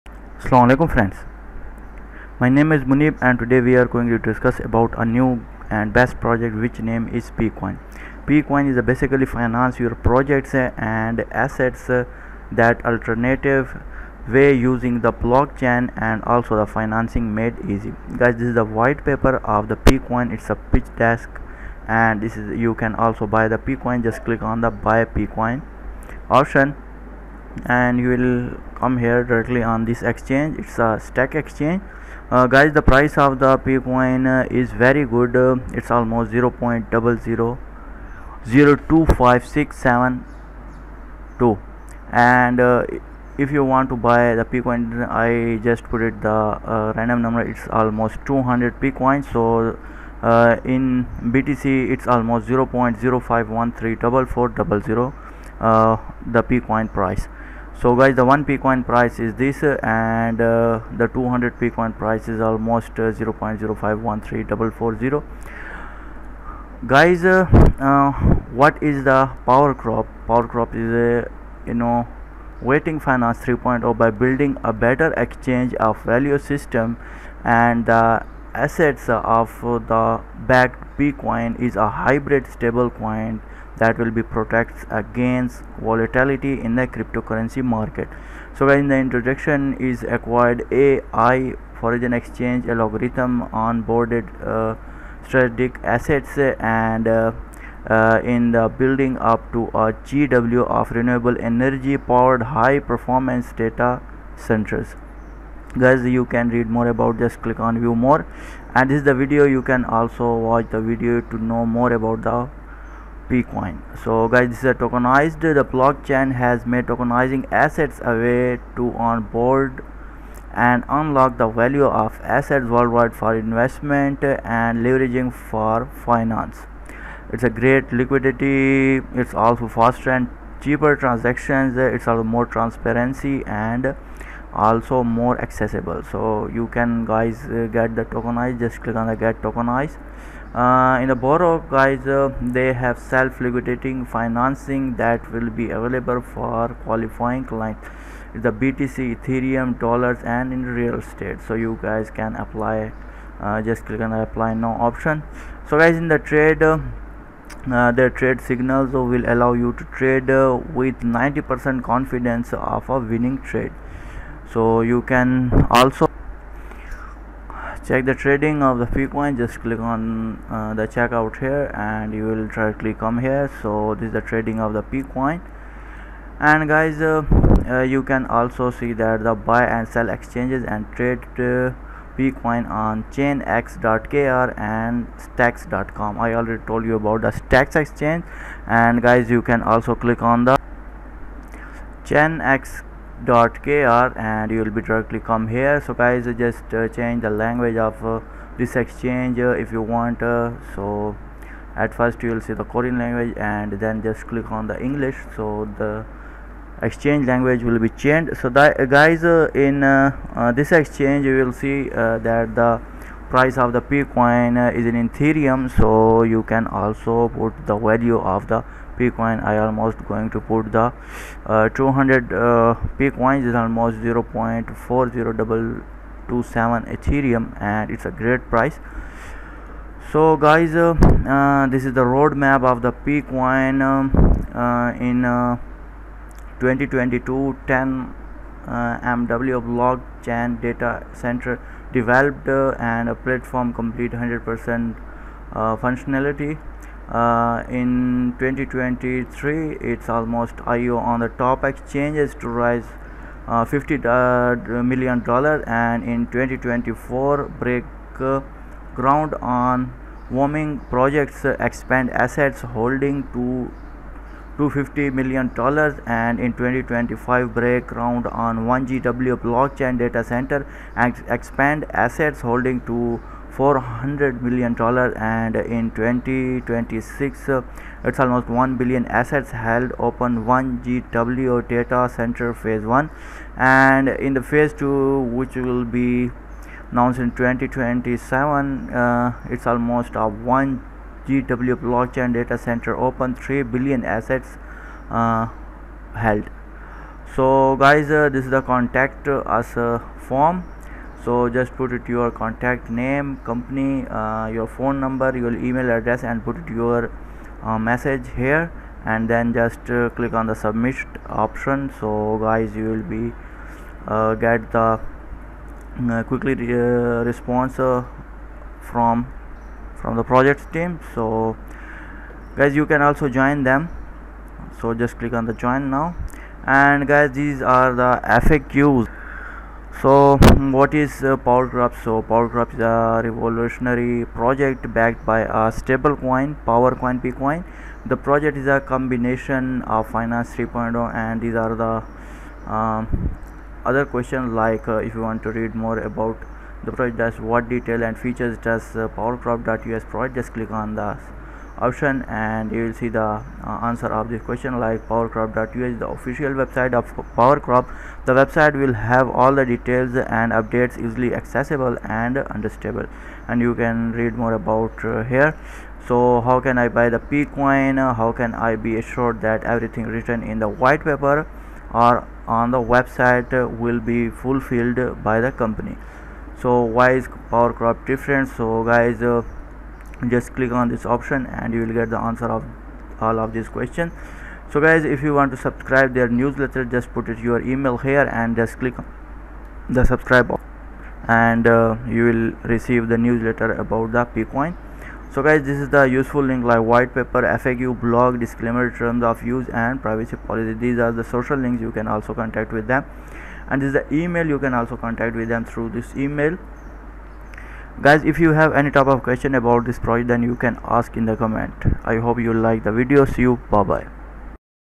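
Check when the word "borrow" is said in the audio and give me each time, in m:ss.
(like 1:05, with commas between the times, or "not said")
2:21.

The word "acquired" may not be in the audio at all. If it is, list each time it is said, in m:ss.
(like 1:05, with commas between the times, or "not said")
1:30.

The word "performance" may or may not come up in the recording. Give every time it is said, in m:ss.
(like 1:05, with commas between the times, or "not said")
1:42.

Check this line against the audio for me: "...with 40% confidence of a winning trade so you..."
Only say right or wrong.
wrong.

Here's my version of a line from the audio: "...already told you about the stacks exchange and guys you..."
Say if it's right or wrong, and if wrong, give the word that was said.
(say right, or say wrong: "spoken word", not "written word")
right.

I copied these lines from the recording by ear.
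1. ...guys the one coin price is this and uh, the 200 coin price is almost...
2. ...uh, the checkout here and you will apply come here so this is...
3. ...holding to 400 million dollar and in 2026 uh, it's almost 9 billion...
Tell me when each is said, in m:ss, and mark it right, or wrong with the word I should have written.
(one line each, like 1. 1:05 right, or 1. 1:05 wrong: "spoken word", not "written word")
1. 0:57 right
2. 2:50 wrong: "directly", not "apply"
3. 4:32 wrong: "1", not "9".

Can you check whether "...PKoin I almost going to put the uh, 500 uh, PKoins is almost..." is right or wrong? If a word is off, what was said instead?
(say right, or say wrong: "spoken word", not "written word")
wrong: "200", not "500".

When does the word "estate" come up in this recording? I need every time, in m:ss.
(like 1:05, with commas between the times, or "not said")
2:30.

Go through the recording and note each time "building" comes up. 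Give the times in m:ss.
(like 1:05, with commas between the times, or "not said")
1:14, 1:38.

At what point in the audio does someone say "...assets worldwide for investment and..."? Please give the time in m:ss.
2:02.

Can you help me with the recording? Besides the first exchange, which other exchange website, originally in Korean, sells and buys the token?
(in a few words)
chainx.kr.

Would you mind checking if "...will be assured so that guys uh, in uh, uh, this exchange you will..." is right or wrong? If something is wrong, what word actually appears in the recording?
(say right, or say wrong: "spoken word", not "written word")
wrong: "changed", not "assured".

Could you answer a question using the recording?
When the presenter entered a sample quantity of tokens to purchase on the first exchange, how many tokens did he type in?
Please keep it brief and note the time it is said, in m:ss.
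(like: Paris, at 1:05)
200, at 0:48.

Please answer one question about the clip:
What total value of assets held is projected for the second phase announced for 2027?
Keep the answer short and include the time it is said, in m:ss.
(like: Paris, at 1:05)
3 billion, at 4:53.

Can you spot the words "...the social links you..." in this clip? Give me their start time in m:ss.
6:41.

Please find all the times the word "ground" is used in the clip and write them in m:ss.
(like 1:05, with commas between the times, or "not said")
4:18, 4:27.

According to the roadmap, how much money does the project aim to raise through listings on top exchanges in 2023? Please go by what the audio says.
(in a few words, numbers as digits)
50 million dollars.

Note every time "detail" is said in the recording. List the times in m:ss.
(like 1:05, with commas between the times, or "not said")
5:47, 5:59.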